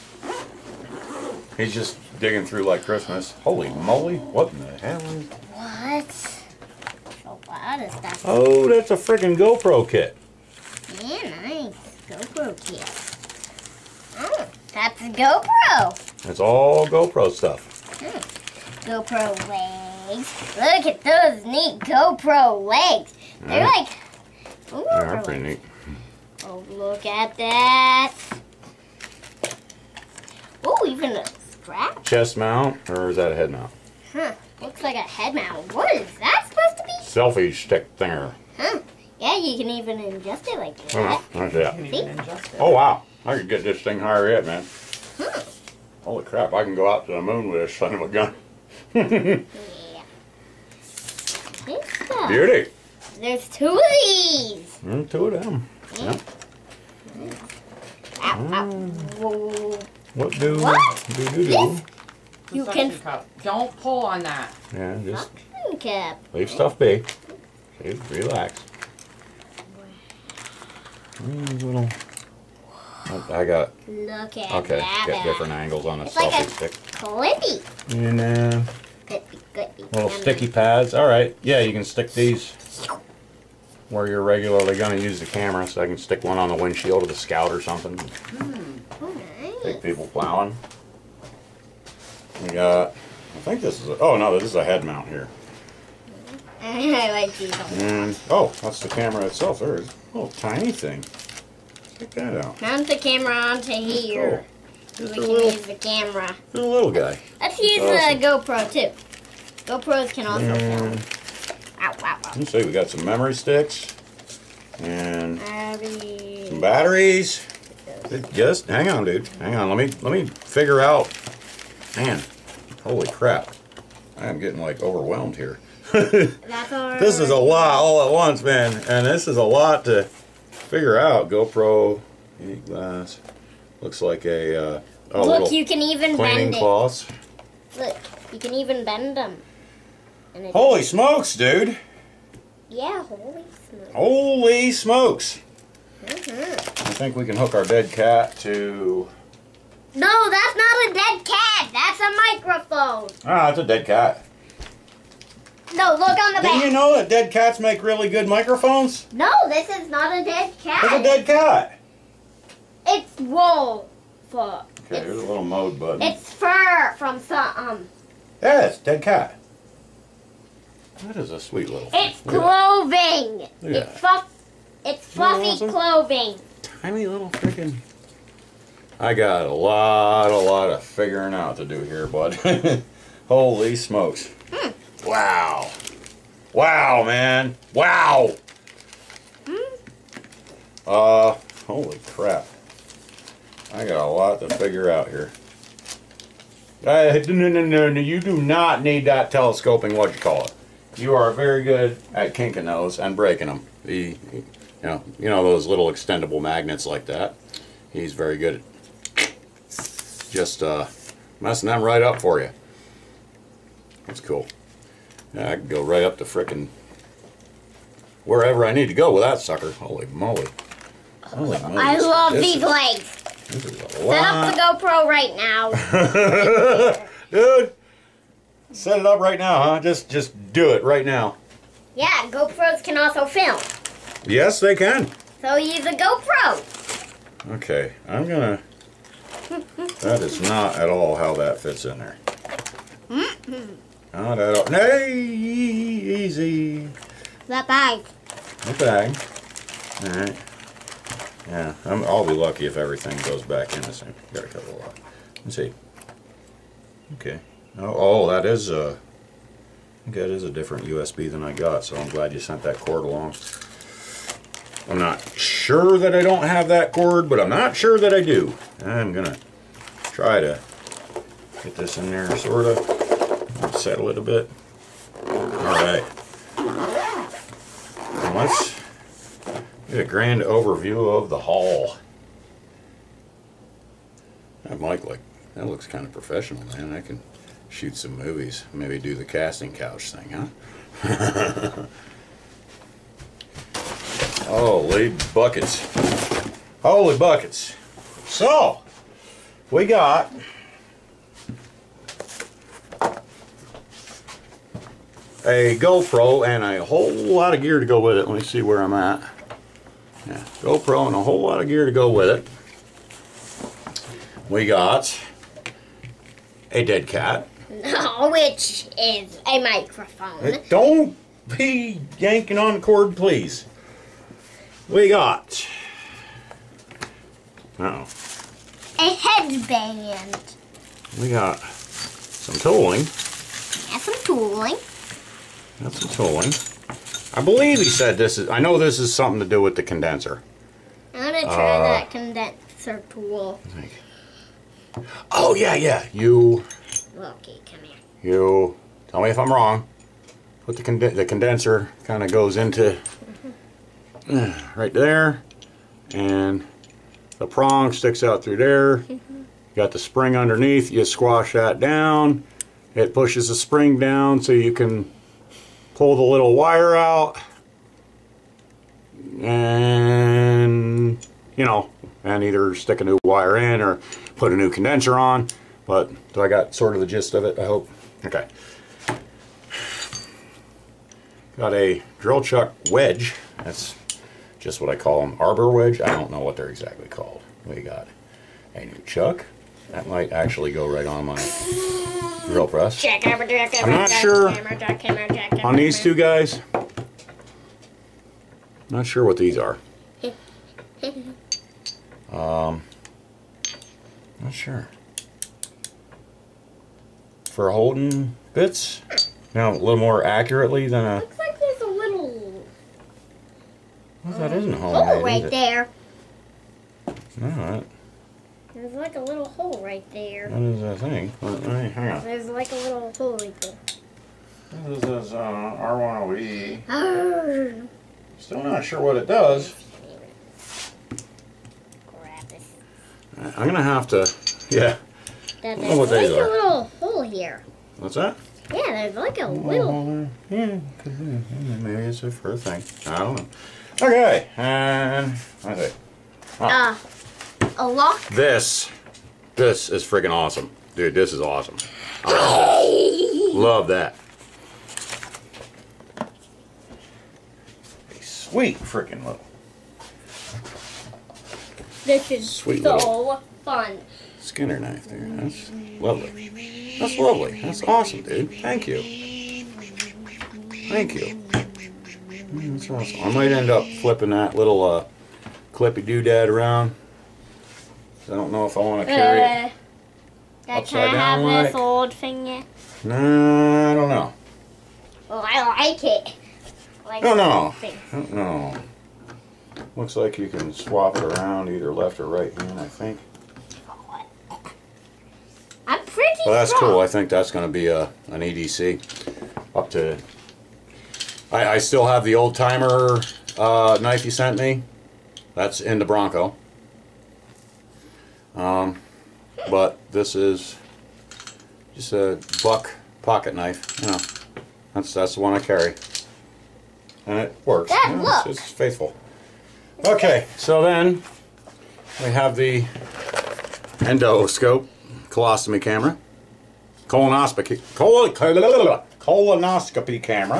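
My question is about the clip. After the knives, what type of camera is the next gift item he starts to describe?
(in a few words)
endoscope.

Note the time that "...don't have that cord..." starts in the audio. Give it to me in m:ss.
4:26.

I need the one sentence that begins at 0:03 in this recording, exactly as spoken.
Holy moly, what in the hell What?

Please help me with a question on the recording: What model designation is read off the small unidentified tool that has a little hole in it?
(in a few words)
R10E.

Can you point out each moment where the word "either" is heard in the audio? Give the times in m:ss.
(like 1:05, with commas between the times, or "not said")
6:12, 8:11.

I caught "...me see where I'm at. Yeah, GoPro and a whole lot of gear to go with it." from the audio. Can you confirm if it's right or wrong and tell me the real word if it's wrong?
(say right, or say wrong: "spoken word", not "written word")
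right.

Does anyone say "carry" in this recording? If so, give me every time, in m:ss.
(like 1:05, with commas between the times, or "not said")
7:59, 8:35.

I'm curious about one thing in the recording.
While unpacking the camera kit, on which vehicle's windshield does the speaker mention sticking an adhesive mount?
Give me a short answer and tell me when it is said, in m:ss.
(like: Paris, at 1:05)
Scout, at 1:27.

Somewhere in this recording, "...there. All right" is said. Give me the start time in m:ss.
6:55.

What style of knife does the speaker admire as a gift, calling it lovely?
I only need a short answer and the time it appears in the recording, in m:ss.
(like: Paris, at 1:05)
Skinner knife, at 7:44.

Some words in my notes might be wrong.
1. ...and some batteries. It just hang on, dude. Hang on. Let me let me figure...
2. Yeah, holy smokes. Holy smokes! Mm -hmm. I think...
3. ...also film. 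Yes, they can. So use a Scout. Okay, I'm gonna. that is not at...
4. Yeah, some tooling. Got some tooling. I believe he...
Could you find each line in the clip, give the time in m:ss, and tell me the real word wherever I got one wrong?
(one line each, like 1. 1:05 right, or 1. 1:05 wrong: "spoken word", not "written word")
1. 1:54 right
2. 2:22 right
3. 3:52 wrong: "GoPro", not "Scout"
4. 5:33 right.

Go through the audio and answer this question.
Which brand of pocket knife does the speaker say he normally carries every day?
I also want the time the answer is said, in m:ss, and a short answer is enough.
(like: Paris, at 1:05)
Buck, at 8:32.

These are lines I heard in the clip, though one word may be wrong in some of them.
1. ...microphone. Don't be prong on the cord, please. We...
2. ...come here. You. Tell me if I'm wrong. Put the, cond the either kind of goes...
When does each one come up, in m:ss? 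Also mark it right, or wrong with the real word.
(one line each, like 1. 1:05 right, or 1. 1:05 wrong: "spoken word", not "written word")
1. 5:19 wrong: "yanking", not "prong"
2. 5:47 wrong: "condenser", not "either".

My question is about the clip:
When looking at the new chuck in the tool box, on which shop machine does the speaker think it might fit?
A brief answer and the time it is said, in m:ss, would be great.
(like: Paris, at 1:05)
drill press, at 6:32.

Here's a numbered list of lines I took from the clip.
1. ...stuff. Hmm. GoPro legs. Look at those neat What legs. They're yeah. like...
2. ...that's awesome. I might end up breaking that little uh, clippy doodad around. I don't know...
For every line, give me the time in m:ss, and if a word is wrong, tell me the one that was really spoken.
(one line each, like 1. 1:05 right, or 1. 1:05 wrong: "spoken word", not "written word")
1. 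0:17 wrong: "GoPro", not "What"
2. 7:52 wrong: "flipping", not "breaking".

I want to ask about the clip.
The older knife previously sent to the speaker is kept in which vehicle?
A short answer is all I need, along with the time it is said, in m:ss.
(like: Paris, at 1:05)
Bronco, at 8:26.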